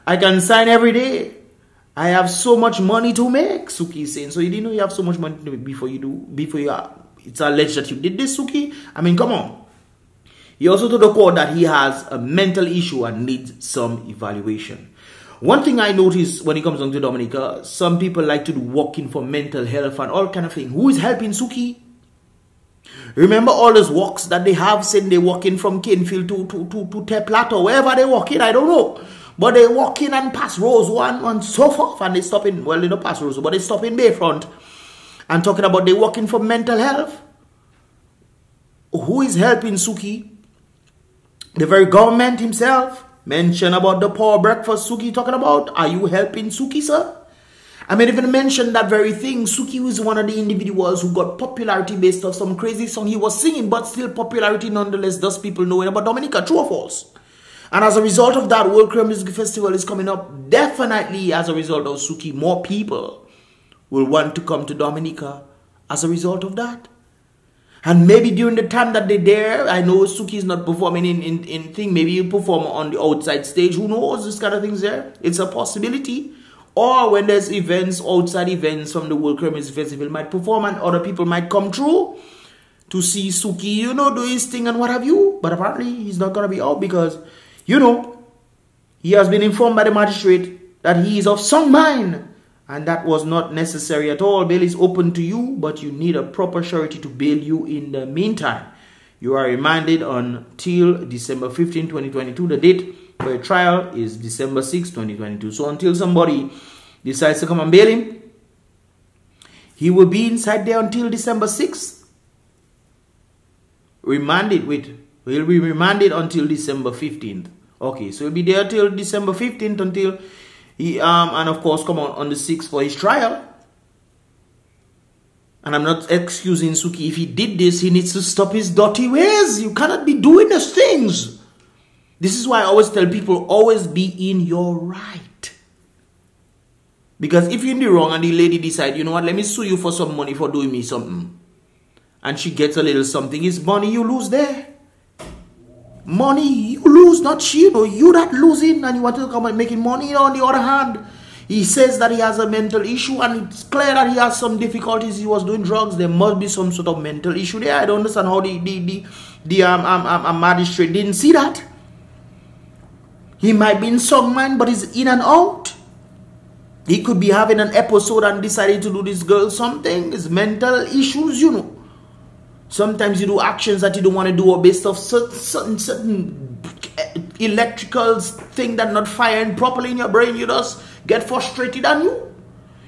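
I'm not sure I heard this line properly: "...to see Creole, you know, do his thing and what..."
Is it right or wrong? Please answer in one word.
wrong.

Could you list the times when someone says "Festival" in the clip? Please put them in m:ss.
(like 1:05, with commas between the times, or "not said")
0:59, 1:19.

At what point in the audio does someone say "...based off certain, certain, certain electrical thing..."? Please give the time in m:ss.
2:54.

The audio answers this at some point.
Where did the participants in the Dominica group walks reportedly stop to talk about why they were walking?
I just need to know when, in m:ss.
0:33.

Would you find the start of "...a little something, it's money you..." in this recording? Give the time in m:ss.
2:22.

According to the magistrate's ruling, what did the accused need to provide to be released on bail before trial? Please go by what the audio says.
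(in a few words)
A proper surety.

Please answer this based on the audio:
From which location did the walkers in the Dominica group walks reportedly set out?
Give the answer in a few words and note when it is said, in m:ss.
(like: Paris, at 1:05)
Canefield, at 0:25.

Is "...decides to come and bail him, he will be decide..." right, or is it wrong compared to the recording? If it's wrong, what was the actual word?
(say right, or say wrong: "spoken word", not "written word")
wrong: "inside", not "decide".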